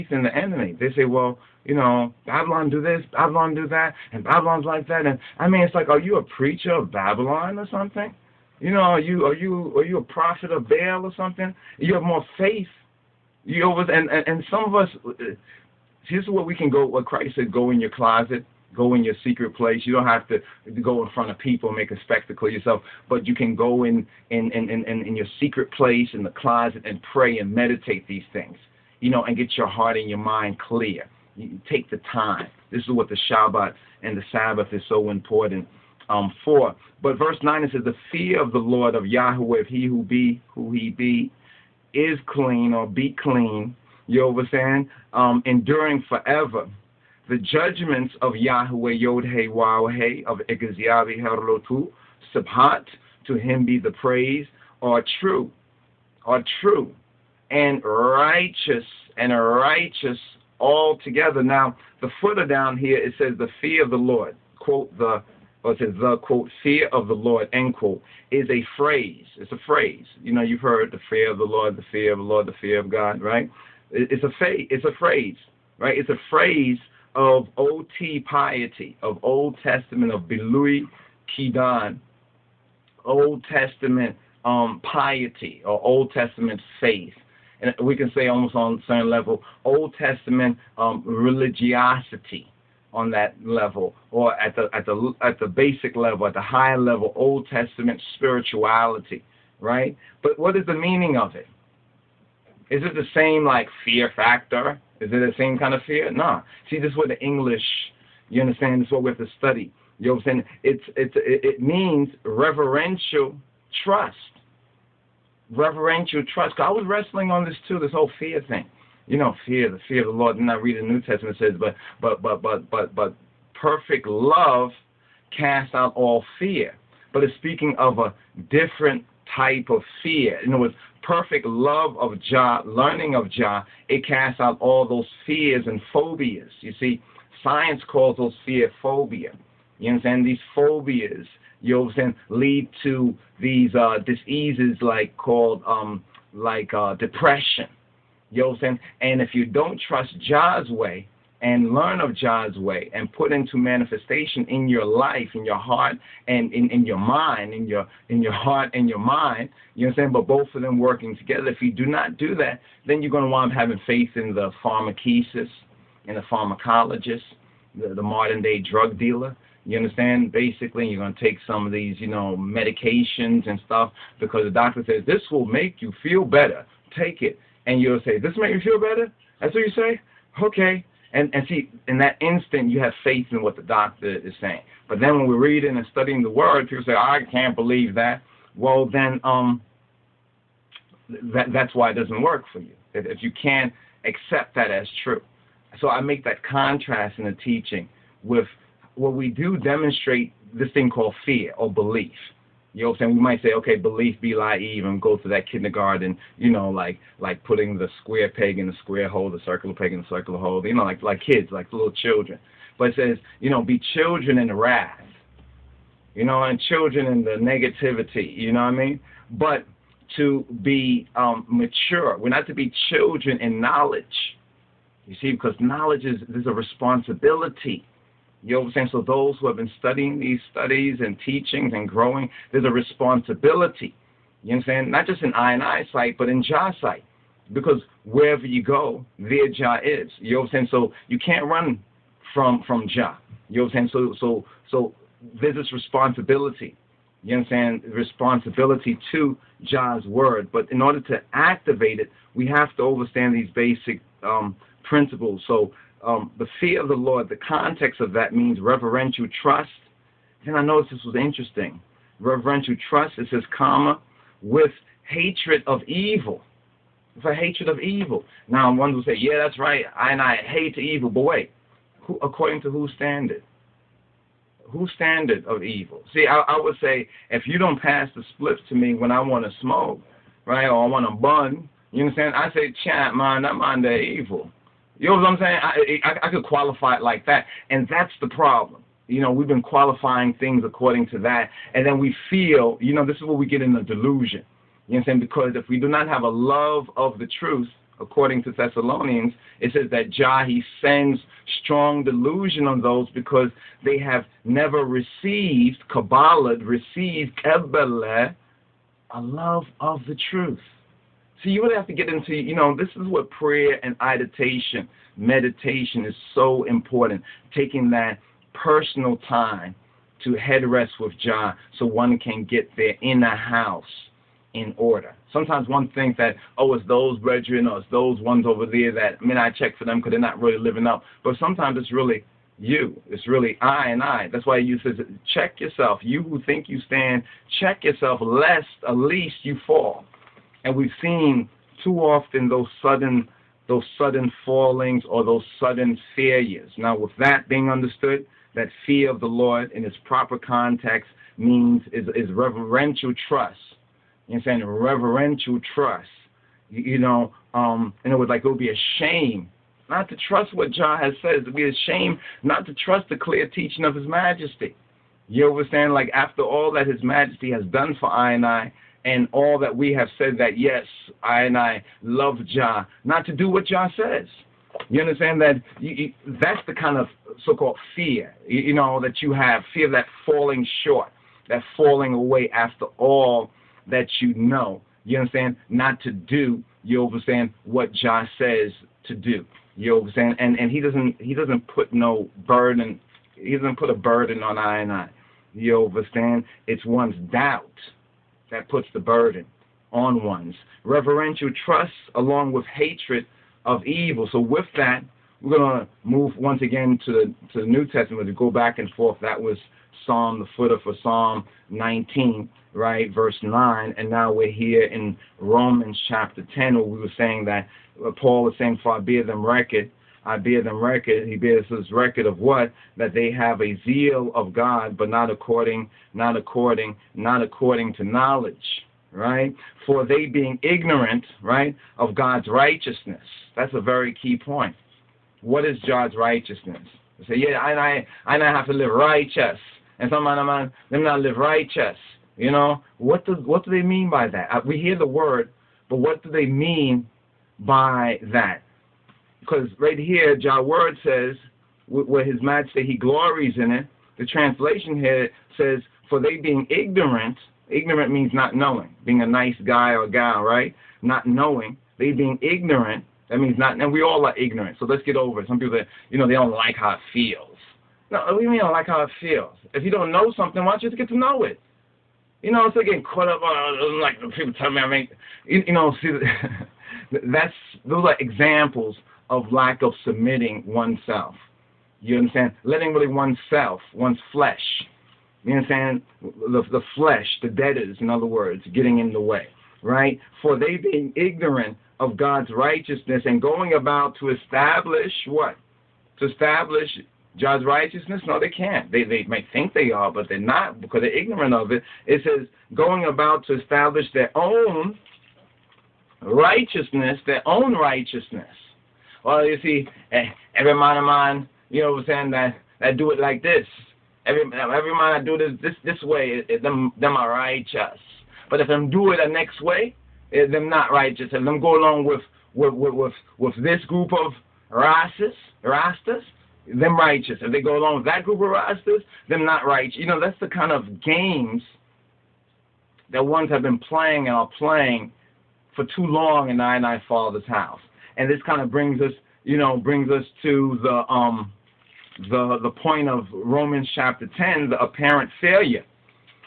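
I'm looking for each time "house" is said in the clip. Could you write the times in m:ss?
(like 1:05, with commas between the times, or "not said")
5:23, 8:57.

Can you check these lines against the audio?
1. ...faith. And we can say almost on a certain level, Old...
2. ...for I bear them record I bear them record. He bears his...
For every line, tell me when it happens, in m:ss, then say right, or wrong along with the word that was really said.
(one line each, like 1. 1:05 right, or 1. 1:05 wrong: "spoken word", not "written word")
1. 1:26 right
2. 6:58 right.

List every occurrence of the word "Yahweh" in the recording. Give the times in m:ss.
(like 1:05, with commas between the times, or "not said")
0:39, 0:48.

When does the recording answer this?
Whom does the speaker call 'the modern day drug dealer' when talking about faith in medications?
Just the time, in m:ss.
2:46.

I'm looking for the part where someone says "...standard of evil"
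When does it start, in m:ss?
4:34.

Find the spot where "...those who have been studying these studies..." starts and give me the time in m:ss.
3:49.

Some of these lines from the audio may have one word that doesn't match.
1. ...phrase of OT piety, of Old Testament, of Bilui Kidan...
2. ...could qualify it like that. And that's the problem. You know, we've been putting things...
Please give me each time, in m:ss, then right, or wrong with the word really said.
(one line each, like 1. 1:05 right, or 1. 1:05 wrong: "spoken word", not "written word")
1. 1:16 right
2. 4:46 wrong: "qualifying", not "putting".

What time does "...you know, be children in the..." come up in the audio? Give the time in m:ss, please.
3:33.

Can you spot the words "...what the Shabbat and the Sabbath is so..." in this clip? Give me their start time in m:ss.
0:32.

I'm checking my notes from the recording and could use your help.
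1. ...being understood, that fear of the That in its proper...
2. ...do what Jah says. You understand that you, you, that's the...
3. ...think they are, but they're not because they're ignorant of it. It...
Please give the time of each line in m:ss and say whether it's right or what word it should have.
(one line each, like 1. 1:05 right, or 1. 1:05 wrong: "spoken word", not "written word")
1. 5:47 wrong: "Lord", not "That"
2. 6:13 right
3. 8:19 right.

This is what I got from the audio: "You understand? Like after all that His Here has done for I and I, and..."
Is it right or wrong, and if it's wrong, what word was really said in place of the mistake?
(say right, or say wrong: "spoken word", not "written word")
wrong: "Majesty", not "Here".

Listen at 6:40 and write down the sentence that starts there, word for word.
Reverential trust along with hatred of evil.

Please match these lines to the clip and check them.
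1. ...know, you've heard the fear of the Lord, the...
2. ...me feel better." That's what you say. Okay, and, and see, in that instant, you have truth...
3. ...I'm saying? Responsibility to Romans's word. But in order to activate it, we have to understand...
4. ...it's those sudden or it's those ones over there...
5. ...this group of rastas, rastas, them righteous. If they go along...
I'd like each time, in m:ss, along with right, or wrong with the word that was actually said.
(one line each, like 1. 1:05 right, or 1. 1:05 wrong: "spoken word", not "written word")
1. 1:10 right
2. 2:58 wrong: "faith", not "truth"
3. 4:07 wrong: "Jah", not "Romans"
4. 5:26 wrong: "brethren", not "sudden"
5. 8:43 right.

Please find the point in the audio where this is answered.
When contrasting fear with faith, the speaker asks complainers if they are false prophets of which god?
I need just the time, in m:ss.
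0:10.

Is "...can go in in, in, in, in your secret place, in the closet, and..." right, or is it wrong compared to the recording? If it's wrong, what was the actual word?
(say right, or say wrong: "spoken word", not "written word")
right.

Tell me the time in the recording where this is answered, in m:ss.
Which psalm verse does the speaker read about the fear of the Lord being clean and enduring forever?
6:50.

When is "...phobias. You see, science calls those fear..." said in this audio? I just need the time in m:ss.
2:15.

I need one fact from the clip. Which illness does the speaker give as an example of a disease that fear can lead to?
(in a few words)
Depression.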